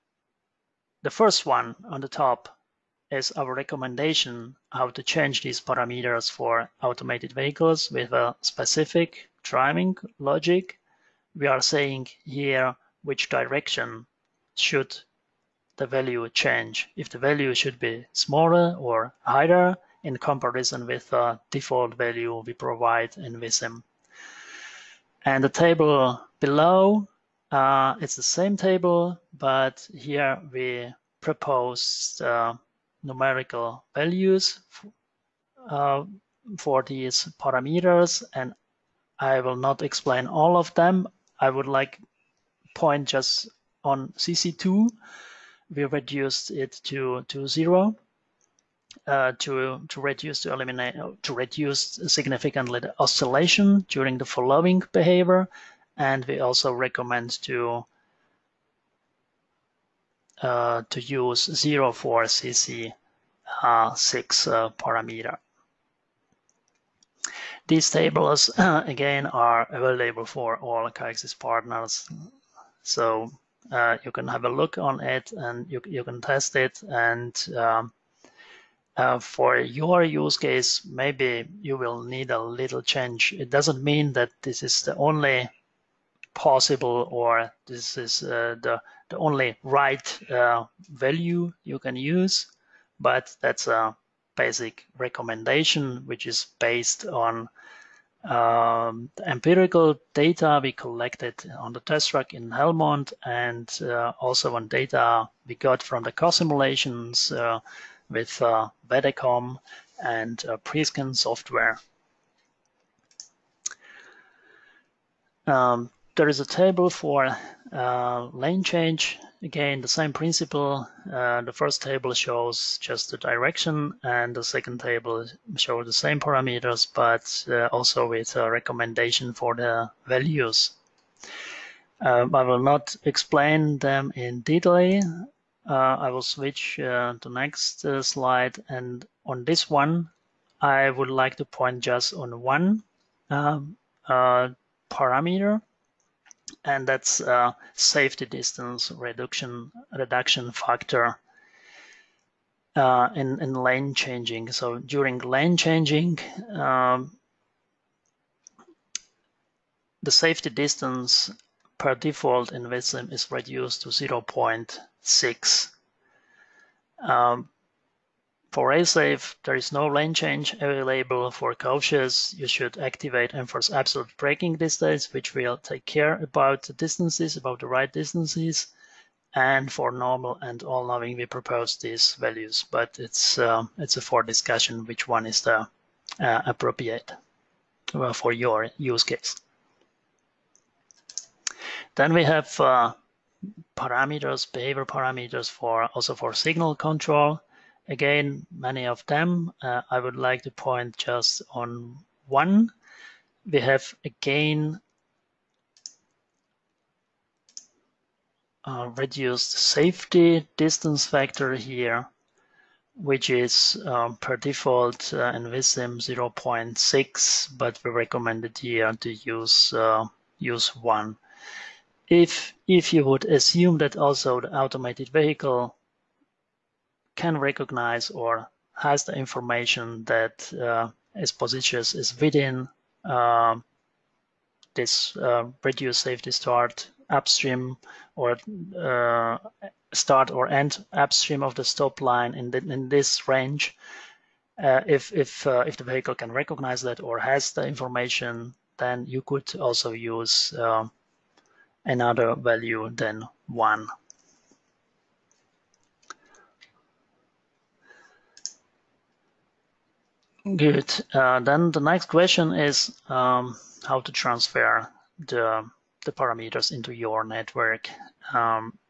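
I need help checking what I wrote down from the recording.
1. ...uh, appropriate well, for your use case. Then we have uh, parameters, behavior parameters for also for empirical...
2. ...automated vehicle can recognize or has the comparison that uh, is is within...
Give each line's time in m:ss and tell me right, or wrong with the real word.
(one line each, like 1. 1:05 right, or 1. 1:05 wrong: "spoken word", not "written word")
1. 3:06 wrong: "signal", not "empirical"
2. 3:44 wrong: "information", not "comparison".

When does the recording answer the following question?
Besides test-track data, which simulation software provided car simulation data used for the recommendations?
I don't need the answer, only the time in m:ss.
1:50.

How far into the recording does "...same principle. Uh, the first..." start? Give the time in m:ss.
1:59.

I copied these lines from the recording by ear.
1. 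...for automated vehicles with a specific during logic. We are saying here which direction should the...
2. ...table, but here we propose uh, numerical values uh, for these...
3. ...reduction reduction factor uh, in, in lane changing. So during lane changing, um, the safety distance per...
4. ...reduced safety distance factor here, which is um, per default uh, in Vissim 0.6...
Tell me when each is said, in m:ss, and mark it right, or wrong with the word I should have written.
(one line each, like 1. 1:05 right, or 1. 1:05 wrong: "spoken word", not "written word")
1. 0:06 wrong: "driving", not "during"
2. 0:28 right
3. 2:28 right
4. 3:28 right.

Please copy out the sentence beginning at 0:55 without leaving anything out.
And we also recommend to uh, to use zero for CC6 uh, uh, parameter.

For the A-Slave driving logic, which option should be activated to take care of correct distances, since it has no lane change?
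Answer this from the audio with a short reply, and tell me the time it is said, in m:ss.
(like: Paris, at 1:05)
Enforce Absolute Braking Distance, at 2:53.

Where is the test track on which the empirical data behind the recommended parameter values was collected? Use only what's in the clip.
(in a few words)
Helmond.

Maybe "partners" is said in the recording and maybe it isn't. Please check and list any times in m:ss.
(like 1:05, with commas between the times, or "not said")
1:11.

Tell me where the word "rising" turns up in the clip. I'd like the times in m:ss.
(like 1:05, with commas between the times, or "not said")
not said.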